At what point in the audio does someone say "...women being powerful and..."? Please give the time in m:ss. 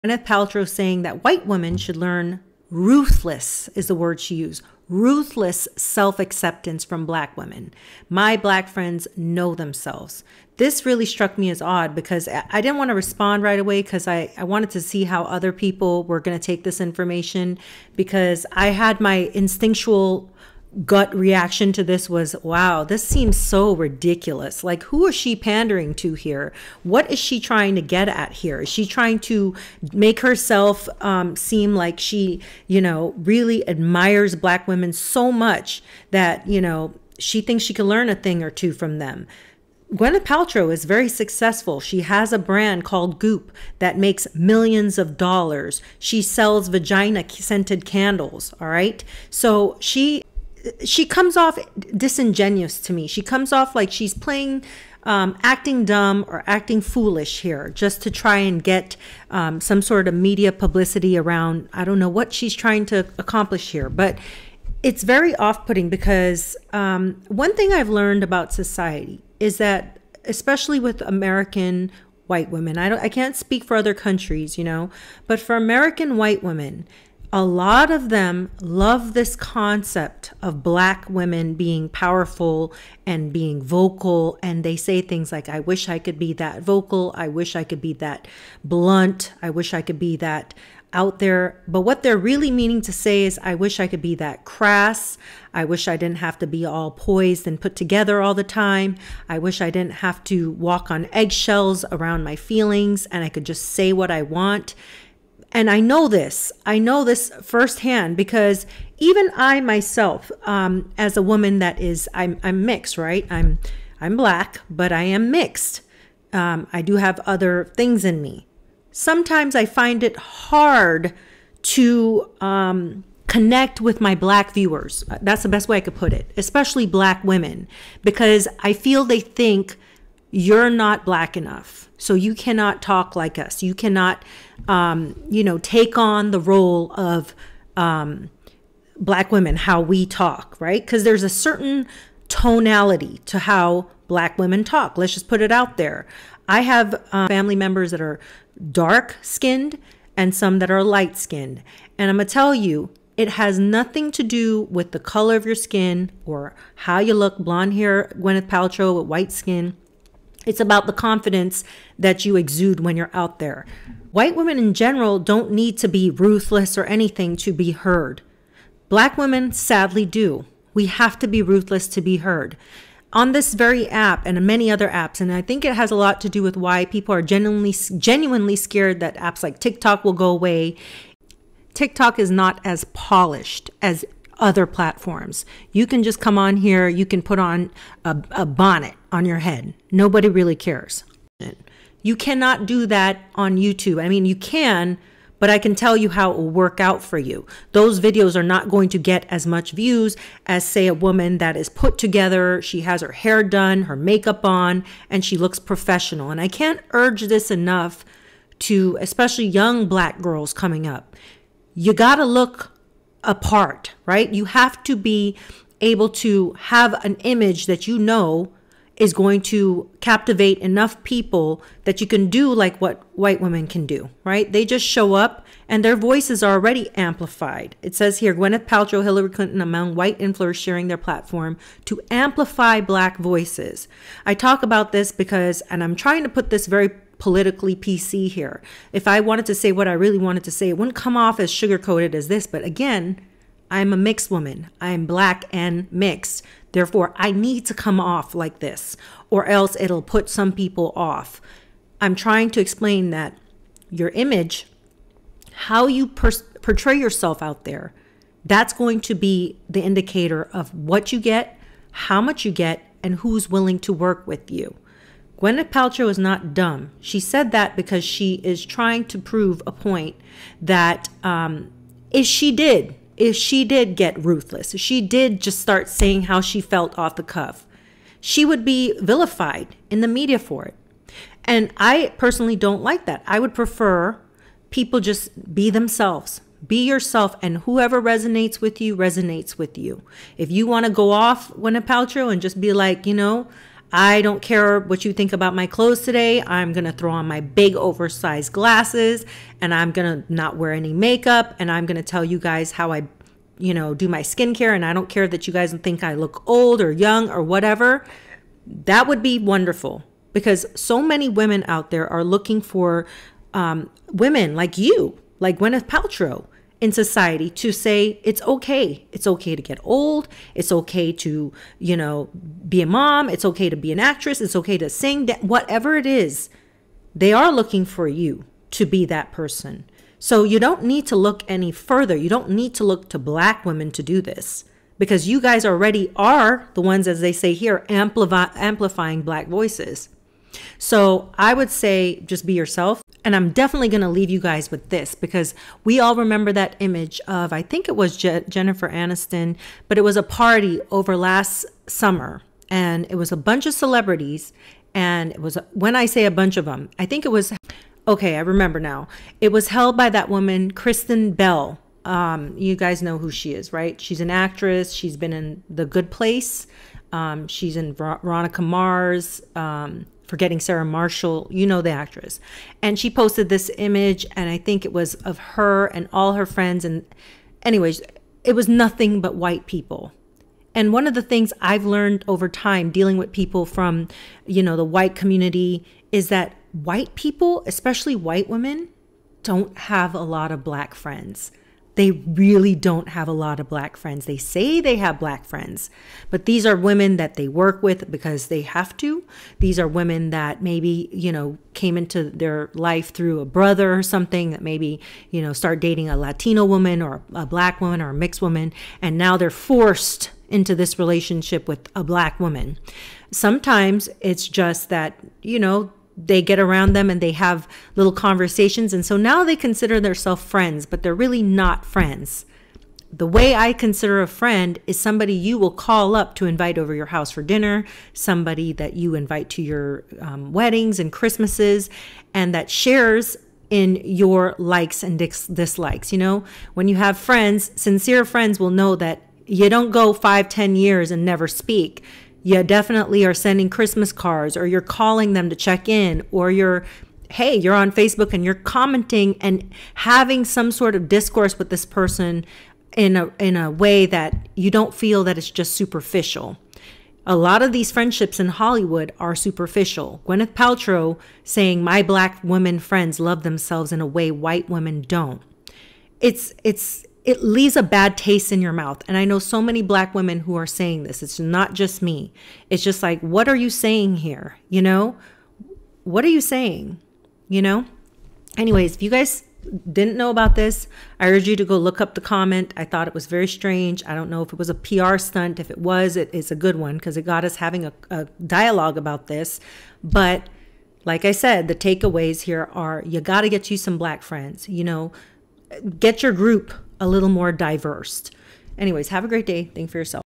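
1:21.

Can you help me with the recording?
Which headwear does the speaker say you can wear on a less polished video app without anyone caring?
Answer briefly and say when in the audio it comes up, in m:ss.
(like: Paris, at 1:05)
a bonnet, at 3:08.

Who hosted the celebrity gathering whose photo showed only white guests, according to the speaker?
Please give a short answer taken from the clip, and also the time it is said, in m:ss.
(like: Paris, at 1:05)
Kristen Bell, at 6:00.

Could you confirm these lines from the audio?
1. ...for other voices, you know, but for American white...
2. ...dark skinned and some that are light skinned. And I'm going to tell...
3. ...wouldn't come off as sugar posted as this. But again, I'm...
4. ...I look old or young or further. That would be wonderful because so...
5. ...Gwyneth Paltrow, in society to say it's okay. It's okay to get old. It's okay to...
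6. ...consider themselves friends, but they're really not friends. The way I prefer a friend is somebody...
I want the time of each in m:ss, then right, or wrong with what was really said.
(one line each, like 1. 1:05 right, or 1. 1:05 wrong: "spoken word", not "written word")
1. 1:13 wrong: "countries", not "voices"
2. 2:28 right
3. 4:00 wrong: "coated", not "posted"
4. 5:06 wrong: "whatever", not "further"
5. 5:15 right
6. 6:59 wrong: "consider", not "prefer".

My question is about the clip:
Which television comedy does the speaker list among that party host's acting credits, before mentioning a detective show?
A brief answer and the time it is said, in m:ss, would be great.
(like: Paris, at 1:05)
The Good Place, at 6:05.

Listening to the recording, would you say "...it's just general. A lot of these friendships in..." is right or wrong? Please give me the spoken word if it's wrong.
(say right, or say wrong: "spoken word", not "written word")
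wrong: "superficial", not "general".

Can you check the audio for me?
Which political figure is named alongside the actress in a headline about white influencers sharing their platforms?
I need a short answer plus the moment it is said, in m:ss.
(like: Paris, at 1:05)
Hillary Clinton, at 3:49.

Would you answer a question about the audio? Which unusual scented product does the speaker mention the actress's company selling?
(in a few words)
vagina scented candles.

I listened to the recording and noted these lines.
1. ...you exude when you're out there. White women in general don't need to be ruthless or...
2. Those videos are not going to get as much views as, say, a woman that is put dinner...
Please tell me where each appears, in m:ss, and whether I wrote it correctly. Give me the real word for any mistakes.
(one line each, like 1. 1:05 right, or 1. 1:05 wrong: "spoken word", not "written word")
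1. 2:42 right
2. 3:17 wrong: "together", not "dinner".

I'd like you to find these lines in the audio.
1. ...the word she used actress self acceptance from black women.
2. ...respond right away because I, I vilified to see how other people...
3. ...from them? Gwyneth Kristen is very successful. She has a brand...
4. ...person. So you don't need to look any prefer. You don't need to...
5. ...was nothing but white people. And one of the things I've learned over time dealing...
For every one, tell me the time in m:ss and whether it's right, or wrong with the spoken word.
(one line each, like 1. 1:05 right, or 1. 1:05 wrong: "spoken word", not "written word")
1. 0:03 wrong: "ruthless", not "actress"
2. 0:12 wrong: "wanted", not "vilified"
3. 0:38 wrong: "Paltrow", not "Kristen"
4. 5:29 wrong: "further", not "prefer"
5. 6:18 right.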